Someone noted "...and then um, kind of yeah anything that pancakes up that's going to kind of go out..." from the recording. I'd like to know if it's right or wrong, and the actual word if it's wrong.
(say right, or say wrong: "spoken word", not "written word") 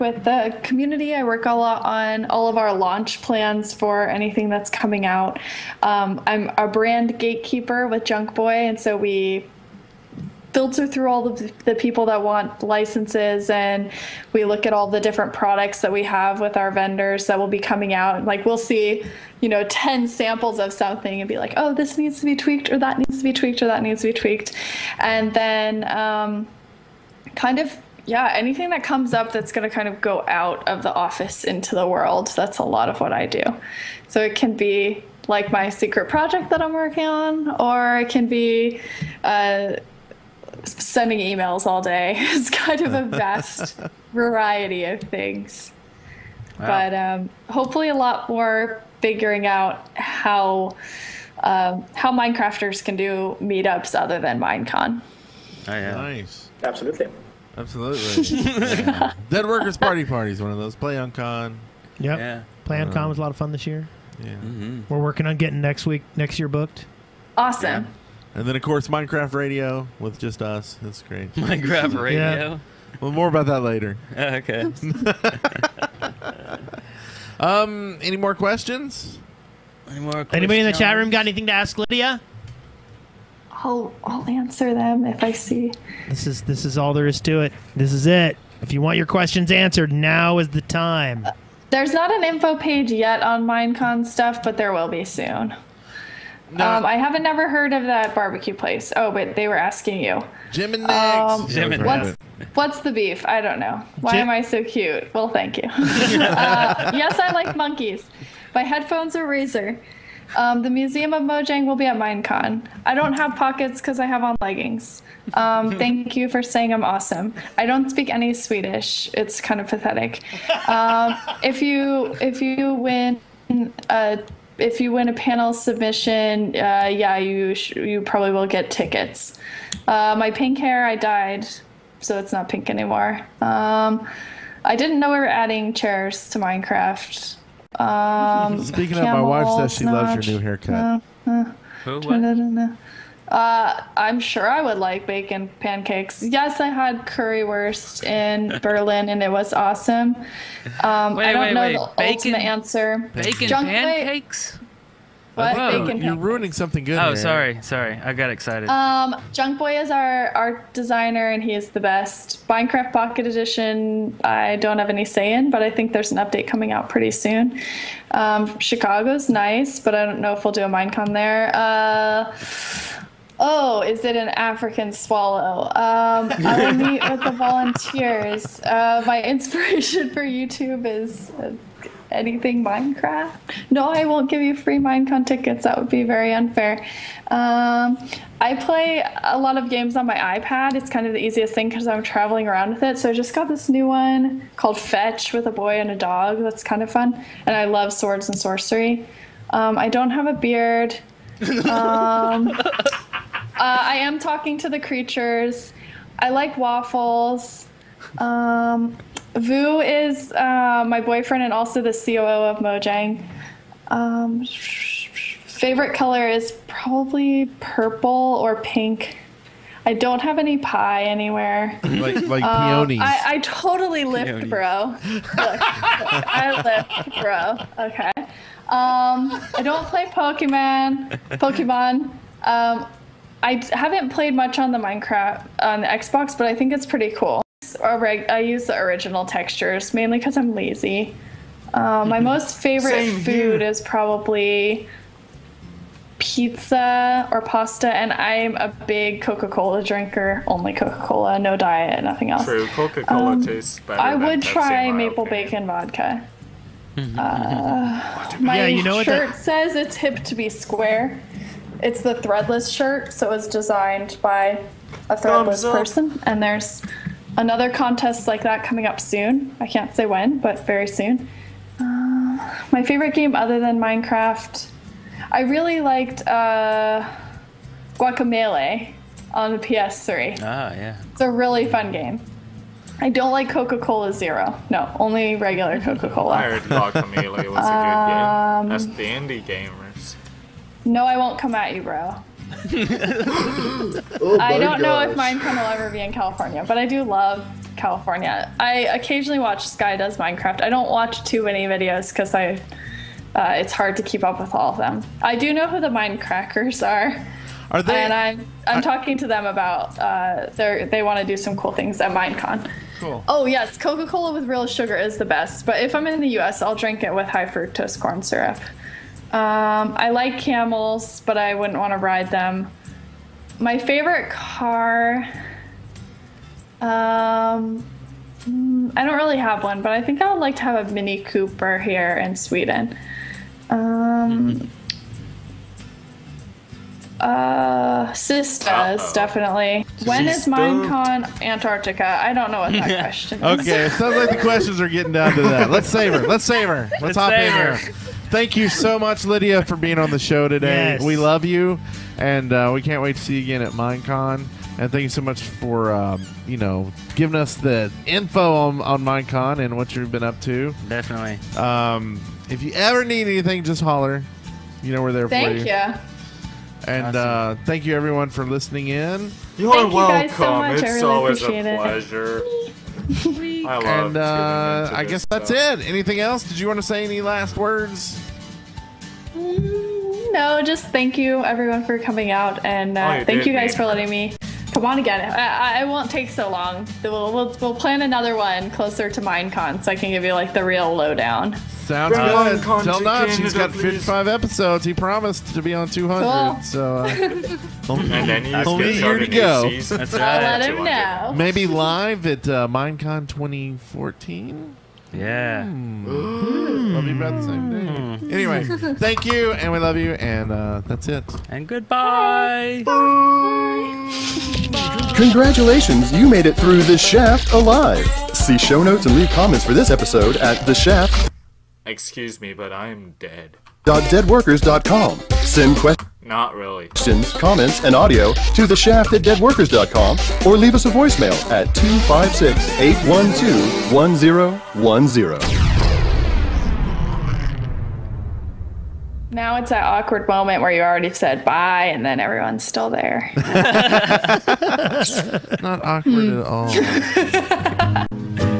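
wrong: "comes", not "pancakes".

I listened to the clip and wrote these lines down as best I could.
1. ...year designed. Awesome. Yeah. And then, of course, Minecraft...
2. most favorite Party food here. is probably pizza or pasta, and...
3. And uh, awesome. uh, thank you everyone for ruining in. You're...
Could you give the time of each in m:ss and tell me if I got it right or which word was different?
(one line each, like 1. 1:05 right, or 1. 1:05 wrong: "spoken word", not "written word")
1. 1:06 wrong: "booked", not "designed"
2. 4:02 wrong: "Same", not "Party"
3. 6:06 wrong: "listening", not "ruining".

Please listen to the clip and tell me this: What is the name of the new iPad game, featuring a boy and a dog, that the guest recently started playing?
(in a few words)
Fetch.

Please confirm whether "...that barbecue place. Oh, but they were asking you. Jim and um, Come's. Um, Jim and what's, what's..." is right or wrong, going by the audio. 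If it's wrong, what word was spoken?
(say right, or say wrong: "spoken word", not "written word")
wrong: "Nick", not "Come".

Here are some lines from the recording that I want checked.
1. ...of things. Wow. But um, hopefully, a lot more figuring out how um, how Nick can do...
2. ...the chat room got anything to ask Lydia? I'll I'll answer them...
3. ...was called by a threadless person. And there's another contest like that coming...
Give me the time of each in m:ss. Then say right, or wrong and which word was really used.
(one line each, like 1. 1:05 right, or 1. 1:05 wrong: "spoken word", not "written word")
1. 0:44 wrong: "Minecrafters", not "Nick"
2. 1:20 right
3. 4:23 wrong: "designed", not "called".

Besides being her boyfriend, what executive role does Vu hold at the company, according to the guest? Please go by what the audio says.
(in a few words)
COO.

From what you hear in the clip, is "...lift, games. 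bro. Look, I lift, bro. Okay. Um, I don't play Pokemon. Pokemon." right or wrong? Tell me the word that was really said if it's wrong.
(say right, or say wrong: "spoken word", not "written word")
wrong: "peonies", not "games".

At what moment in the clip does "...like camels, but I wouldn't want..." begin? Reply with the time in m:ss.
5:20.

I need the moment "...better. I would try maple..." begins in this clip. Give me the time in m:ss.
4:13.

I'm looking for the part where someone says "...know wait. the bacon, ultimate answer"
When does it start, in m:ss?
2:31.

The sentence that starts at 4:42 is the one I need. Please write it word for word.
I don't like Coca Cola Zero.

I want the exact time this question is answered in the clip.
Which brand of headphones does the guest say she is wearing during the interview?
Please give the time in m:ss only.
1:49.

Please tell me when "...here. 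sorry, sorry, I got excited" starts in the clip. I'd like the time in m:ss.
2:37.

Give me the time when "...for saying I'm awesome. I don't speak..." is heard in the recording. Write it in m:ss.
1:56.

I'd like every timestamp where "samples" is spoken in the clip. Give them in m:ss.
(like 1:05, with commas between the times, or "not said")
0:20.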